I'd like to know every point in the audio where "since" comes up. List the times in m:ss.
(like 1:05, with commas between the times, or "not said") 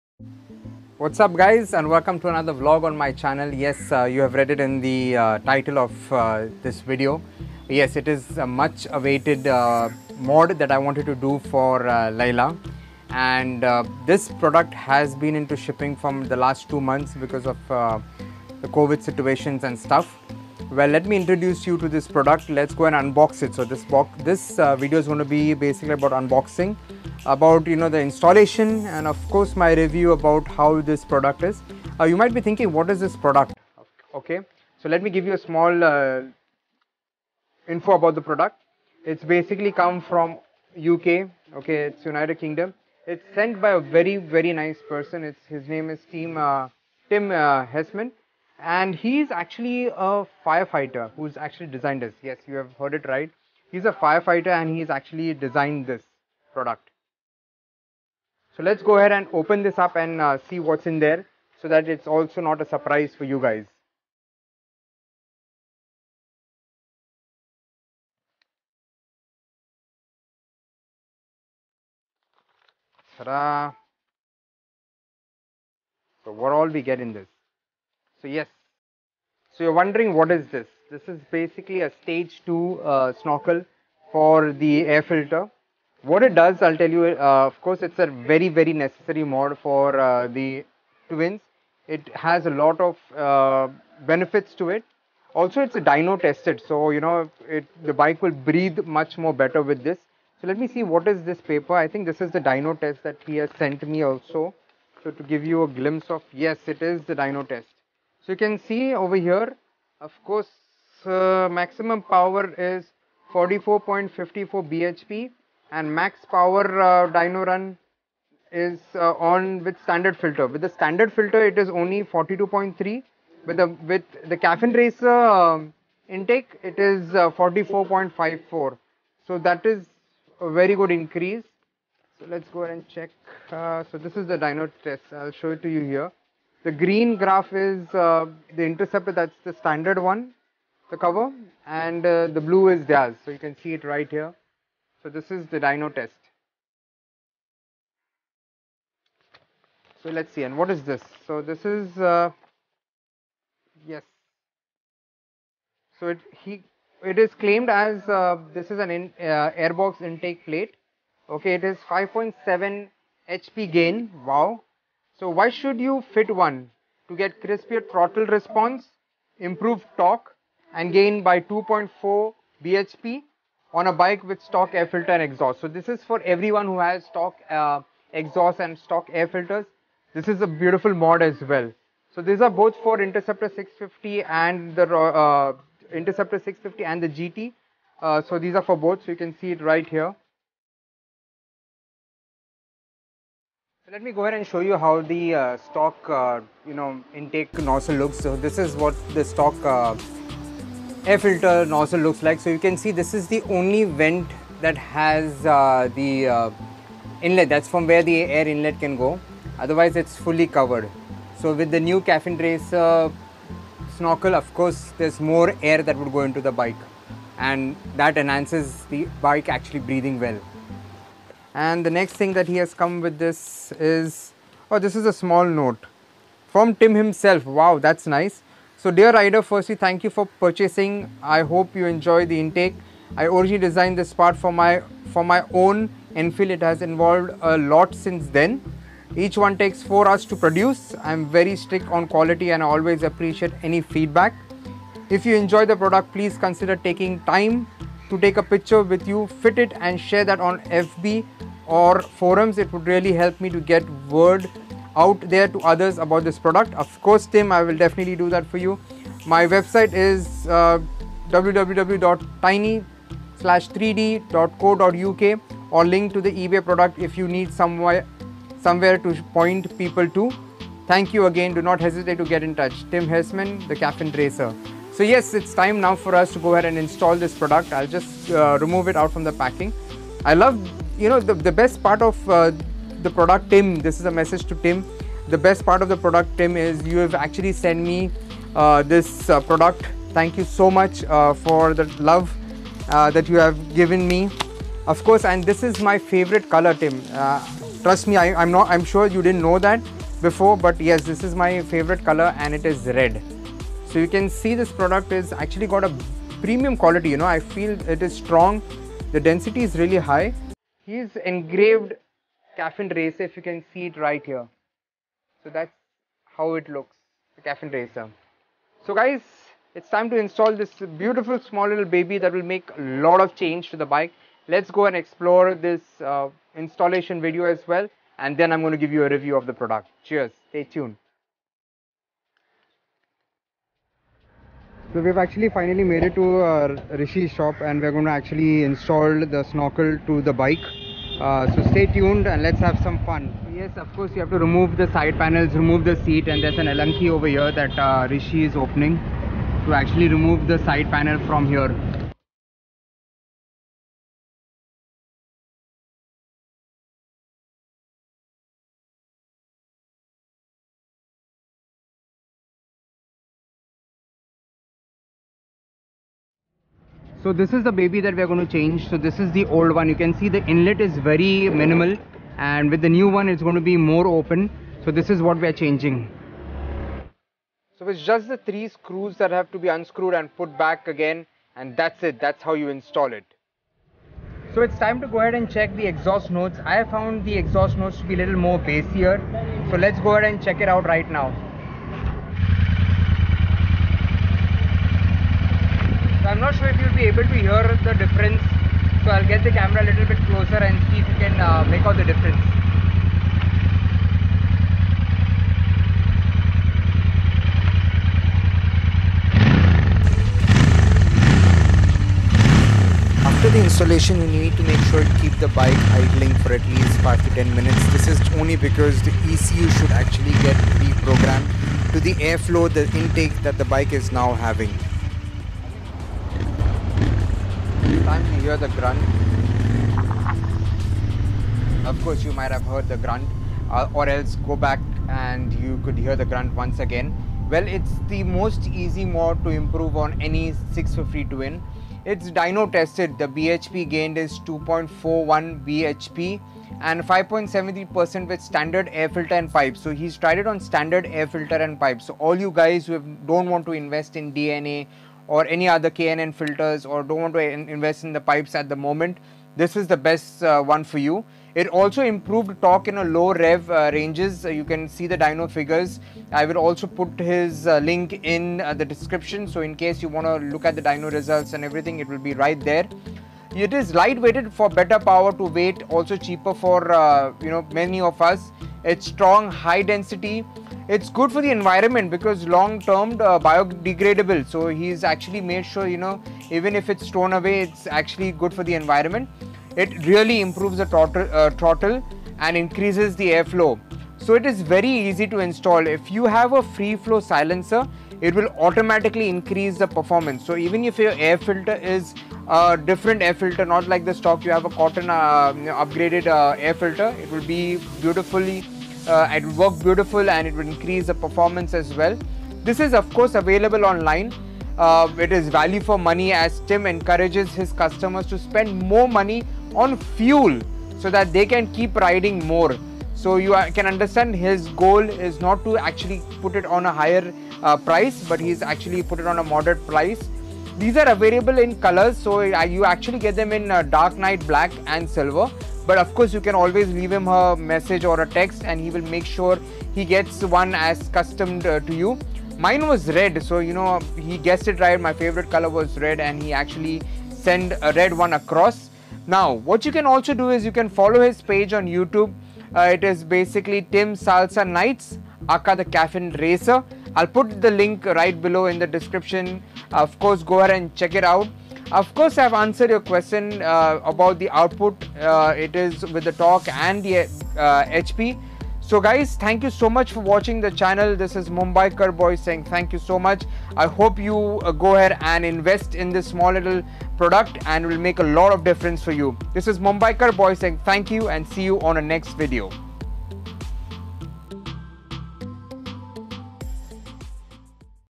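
3:57.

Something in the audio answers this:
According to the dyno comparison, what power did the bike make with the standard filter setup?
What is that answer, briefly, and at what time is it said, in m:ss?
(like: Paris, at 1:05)
42.3, at 2:02.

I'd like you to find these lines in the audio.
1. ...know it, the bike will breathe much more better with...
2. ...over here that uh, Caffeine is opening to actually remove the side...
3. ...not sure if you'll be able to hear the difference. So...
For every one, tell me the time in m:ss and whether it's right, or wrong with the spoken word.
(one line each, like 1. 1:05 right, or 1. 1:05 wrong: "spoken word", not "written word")
1. 1:36 right
2. 5:47 wrong: "Rishi", not "Caffeine"
3. 6:36 right.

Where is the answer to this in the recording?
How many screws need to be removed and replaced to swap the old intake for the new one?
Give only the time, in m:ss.
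6:18.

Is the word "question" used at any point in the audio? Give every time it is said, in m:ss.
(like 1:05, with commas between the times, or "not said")
9:22.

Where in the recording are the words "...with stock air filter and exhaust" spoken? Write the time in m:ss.
2:54.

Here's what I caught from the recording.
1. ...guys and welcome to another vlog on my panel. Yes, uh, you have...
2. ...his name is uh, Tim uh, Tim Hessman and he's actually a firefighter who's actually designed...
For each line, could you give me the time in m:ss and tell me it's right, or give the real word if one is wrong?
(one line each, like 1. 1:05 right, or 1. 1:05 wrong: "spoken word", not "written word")
1. 0:01 wrong: "channel", not "panel"
2. 0:45 right.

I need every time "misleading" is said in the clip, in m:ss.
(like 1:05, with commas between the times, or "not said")
not said.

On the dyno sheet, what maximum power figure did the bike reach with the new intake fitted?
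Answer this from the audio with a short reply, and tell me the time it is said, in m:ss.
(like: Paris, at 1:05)
44.54 bhp, at 1:53.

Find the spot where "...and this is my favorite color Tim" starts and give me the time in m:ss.
4:55.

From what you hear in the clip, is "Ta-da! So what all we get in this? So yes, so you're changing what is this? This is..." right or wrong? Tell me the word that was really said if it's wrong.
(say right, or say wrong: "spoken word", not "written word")
wrong: "wondering", not "changing".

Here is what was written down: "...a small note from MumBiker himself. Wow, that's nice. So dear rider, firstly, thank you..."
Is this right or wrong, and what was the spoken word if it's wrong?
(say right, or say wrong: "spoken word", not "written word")
wrong: "Tim", not "MumBiker".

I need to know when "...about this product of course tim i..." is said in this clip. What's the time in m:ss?
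4:15.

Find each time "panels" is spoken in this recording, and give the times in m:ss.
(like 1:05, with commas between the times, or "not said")
5:45, 5:50.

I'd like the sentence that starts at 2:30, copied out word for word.
So let's see and what is this?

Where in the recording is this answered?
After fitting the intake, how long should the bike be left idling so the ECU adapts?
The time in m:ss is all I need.
6:57.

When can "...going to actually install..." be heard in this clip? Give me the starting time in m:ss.
5:37.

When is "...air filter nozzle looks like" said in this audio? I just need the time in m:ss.
3:21.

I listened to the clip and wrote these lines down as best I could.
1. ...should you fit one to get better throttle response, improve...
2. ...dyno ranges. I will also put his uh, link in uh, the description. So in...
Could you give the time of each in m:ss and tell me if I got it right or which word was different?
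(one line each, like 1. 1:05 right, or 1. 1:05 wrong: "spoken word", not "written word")
1. 2:45 wrong: "crispier", not "better"
2. 7:45 wrong: "figures", not "ranges".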